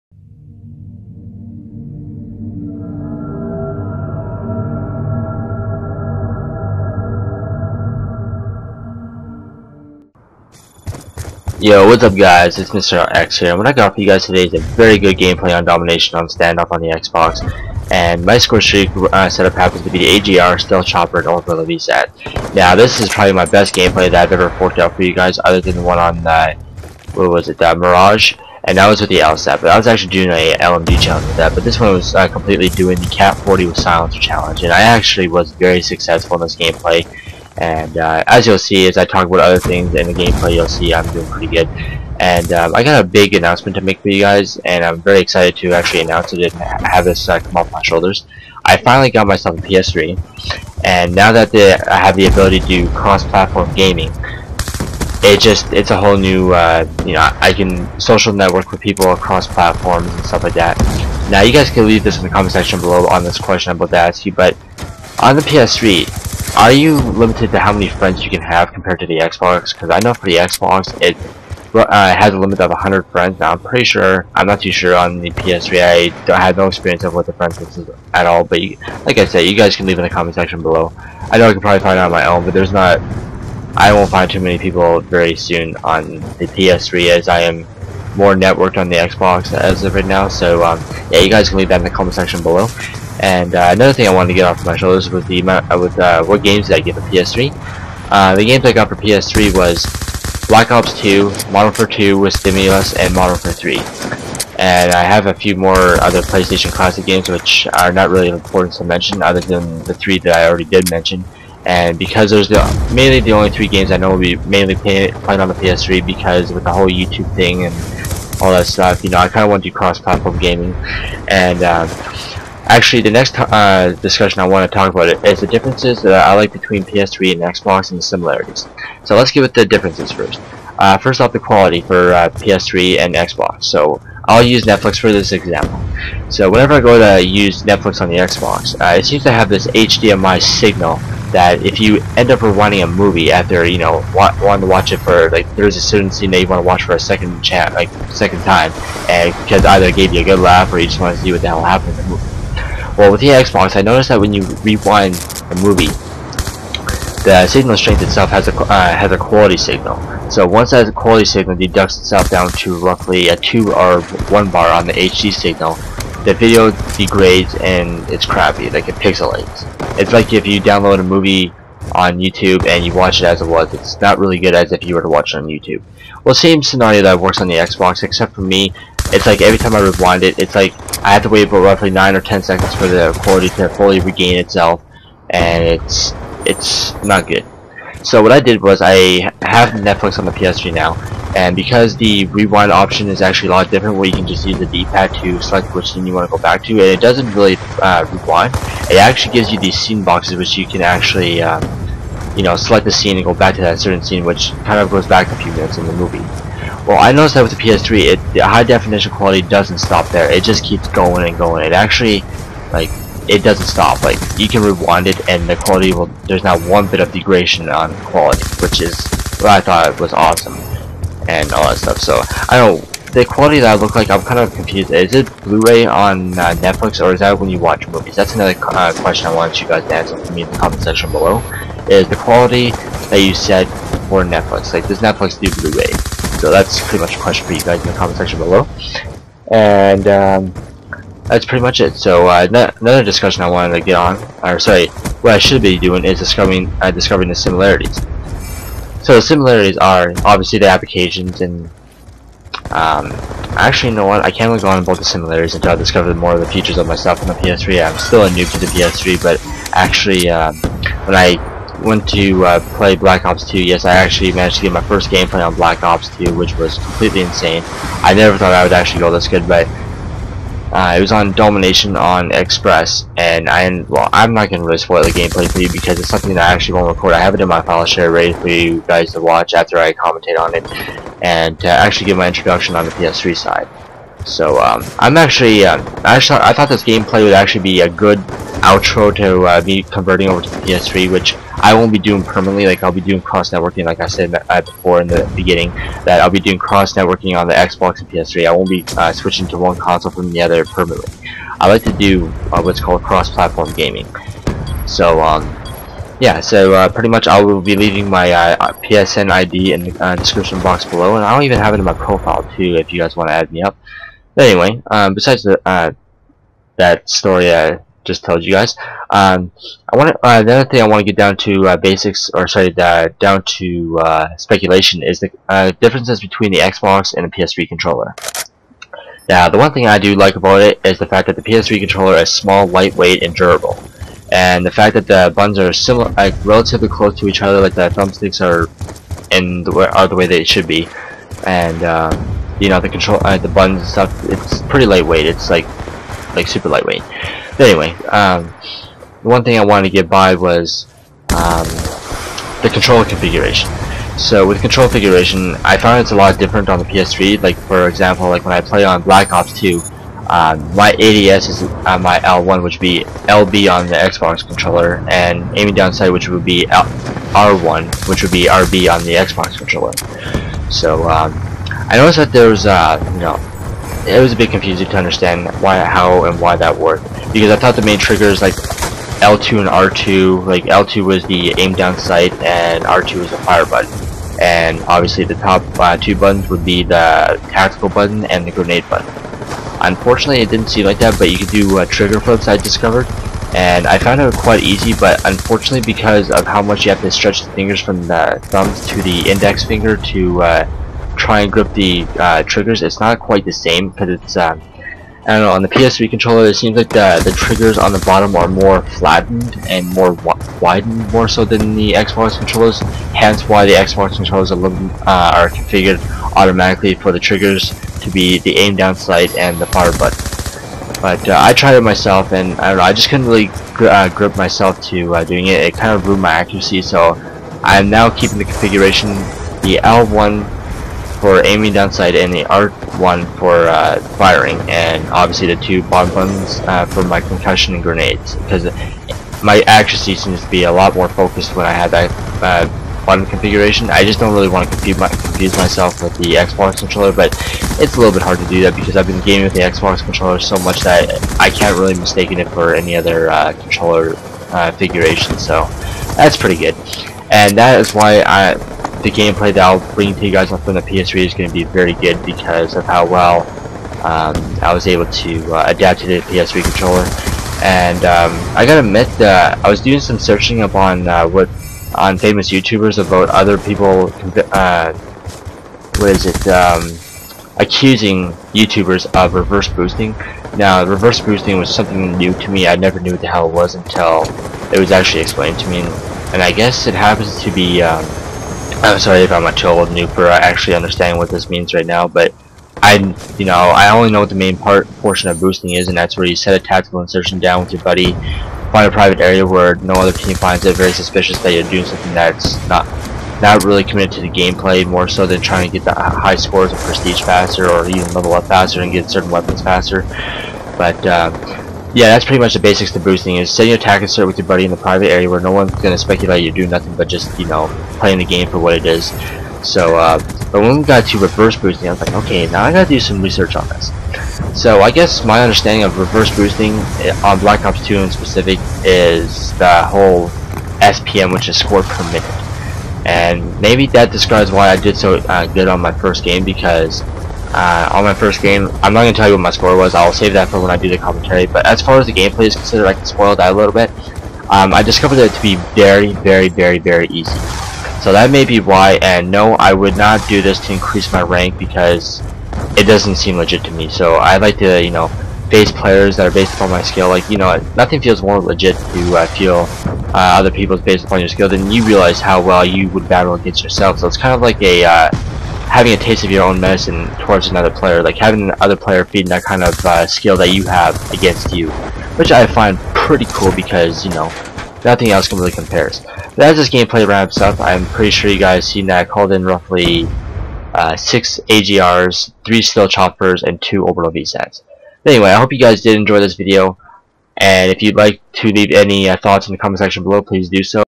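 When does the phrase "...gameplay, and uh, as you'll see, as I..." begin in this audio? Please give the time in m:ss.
0:36.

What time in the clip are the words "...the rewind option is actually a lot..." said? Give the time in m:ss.
3:11.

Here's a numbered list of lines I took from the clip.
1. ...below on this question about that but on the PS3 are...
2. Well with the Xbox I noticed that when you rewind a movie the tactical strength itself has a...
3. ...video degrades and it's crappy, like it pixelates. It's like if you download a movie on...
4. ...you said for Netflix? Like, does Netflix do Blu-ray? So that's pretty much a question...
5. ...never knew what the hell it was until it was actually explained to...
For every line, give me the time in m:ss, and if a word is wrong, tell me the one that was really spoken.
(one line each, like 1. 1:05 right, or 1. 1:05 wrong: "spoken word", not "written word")
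1. 1:02 right
2. 2:32 wrong: "signal", not "tactical"
3. 2:46 right
4. 3:53 right
5. 8:02 right.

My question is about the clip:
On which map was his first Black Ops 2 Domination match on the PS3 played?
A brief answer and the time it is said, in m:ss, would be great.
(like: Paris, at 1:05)
Express, at 4:32.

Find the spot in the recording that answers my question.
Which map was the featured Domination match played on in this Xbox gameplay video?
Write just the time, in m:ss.
0:16.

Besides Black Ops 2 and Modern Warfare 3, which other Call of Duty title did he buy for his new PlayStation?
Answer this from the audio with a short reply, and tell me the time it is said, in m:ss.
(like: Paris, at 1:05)
Modern Warfare 2, at 1:41.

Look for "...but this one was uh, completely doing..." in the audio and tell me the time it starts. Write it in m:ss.
0:31.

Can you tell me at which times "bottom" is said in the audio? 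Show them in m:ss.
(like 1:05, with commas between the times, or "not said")
6:47, 7:15.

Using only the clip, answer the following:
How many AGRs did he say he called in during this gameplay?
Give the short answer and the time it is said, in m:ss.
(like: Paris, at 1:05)
6, at 9:40.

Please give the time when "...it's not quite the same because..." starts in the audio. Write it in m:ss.
6:42.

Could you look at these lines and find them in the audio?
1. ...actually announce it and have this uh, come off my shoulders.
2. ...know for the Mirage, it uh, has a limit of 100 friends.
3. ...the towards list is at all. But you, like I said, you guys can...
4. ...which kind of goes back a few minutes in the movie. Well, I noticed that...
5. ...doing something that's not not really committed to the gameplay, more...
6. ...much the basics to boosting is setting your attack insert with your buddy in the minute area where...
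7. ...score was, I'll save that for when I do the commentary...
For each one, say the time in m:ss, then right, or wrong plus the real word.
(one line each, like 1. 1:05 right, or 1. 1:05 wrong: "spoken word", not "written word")
1. 0:45 right
2. 1:10 wrong: "Xbox", not "Mirage"
3. 1:17 wrong: "friends", not "towards"
4. 3:24 right
5. 8:21 right
6. 8:32 wrong: "private", not "minute"
7. 8:59 right.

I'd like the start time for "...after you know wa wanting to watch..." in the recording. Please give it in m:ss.
2:23.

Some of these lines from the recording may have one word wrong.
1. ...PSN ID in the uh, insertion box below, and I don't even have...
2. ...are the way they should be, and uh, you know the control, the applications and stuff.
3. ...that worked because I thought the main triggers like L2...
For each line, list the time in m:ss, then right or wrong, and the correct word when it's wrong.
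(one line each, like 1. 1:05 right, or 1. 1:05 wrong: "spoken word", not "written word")
1. 5:08 wrong: "description", not "insertion"
2. 5:39 wrong: "buttons", not "applications"
3. 6:16 right.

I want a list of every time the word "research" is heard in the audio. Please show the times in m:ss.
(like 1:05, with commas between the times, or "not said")
8:43.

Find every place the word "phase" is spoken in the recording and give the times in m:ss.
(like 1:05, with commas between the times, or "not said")
not said.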